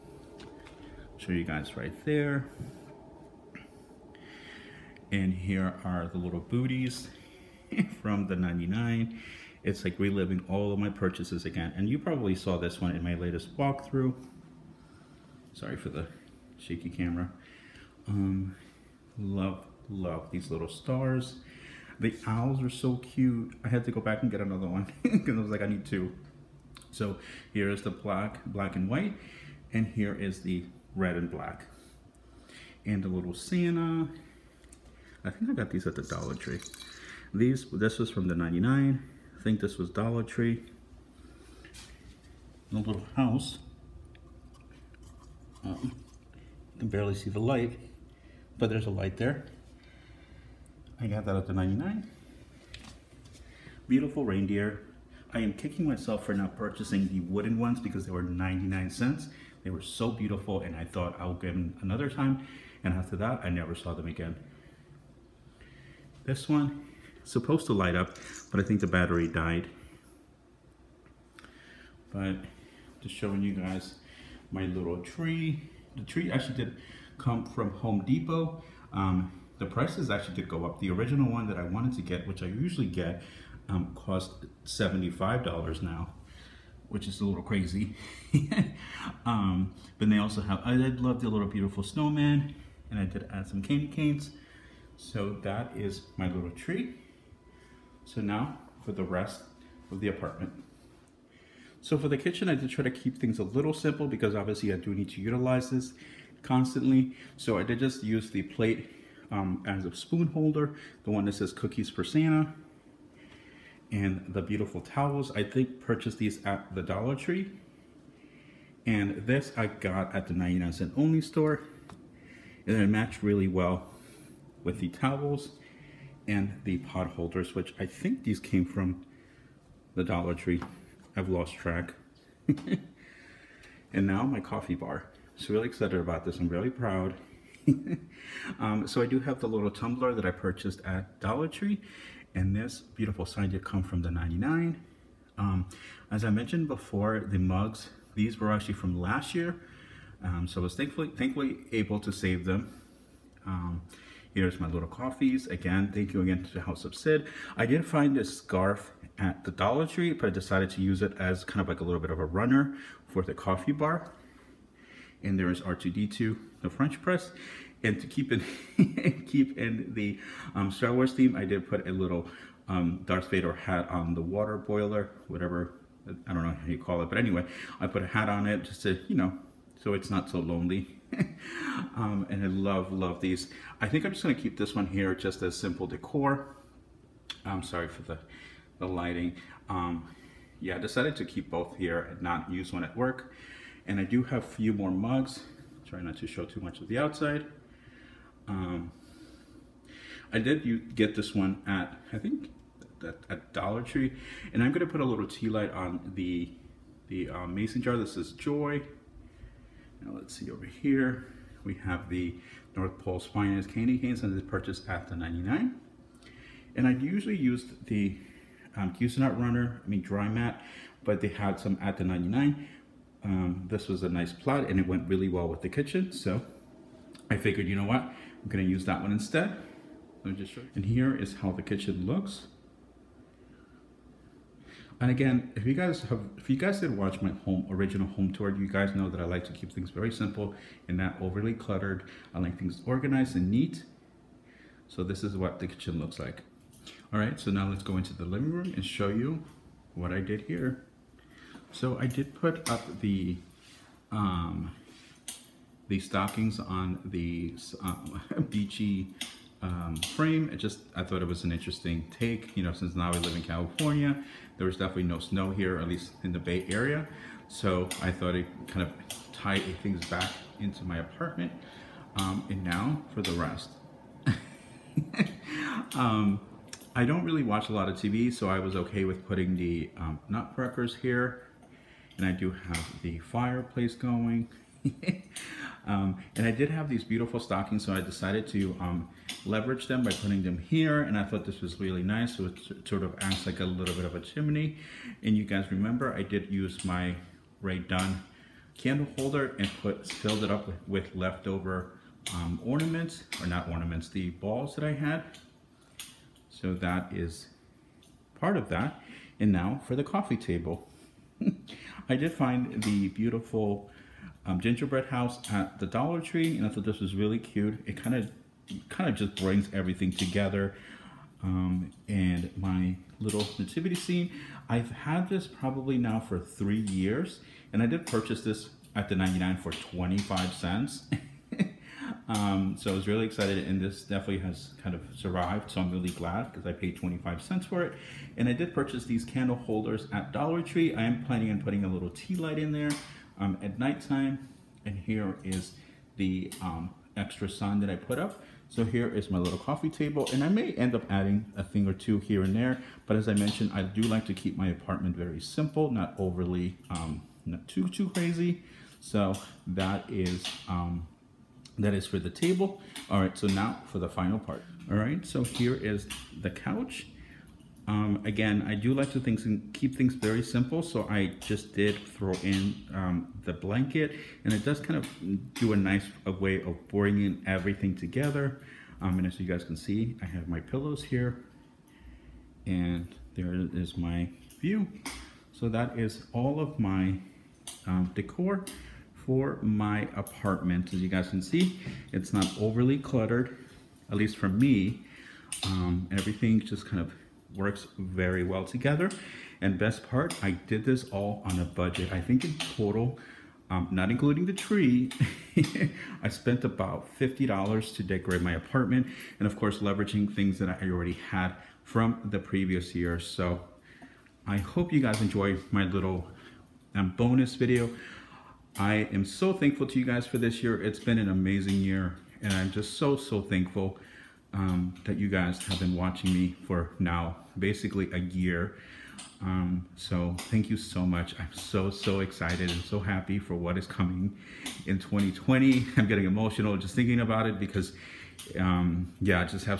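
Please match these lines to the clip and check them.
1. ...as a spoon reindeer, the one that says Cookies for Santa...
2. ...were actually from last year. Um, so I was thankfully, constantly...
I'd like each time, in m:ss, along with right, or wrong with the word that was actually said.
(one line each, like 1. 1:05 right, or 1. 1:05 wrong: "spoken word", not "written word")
1. 1:49 wrong: "holder", not "reindeer"
2. 2:28 wrong: "thankfully", not "constantly".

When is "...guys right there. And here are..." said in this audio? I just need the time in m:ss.
0:01.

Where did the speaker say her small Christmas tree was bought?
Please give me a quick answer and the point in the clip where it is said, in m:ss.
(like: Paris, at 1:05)
Home Depot, at 1:17.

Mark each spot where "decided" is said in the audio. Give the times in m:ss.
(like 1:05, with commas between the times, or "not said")
2:40, 3:10, 4:48.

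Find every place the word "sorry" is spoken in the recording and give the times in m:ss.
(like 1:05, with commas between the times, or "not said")
0:15, 3:07.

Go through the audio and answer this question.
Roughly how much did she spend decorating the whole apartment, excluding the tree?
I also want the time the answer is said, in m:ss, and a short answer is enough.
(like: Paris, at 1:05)
$50, at 6:47.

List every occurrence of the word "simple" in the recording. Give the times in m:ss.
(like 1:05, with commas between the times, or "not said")
1:43, 3:05, 4:00, 5:55, 6:10.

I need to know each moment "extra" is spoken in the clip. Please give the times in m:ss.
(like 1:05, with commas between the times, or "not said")
5:47.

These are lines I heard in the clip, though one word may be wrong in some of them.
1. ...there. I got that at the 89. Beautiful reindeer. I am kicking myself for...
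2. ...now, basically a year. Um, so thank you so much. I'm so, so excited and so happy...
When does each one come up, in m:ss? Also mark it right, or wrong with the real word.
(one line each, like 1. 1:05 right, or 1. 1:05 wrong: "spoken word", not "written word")
1. 0:49 wrong: "99", not "89"
2. 7:06 right.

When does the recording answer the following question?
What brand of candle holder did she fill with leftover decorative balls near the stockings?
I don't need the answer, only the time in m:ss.
4:57.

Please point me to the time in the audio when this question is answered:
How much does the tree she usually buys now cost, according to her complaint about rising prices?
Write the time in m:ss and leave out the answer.
1:24.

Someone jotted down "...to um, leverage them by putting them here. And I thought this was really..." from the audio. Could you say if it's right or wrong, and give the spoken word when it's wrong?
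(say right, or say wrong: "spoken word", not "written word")
right.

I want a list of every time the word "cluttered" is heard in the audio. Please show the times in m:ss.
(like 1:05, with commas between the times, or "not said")
4:01, 6:32.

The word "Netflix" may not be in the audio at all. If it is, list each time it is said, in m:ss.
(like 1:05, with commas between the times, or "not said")
not said.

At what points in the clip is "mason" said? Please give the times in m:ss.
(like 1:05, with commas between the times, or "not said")
3:27.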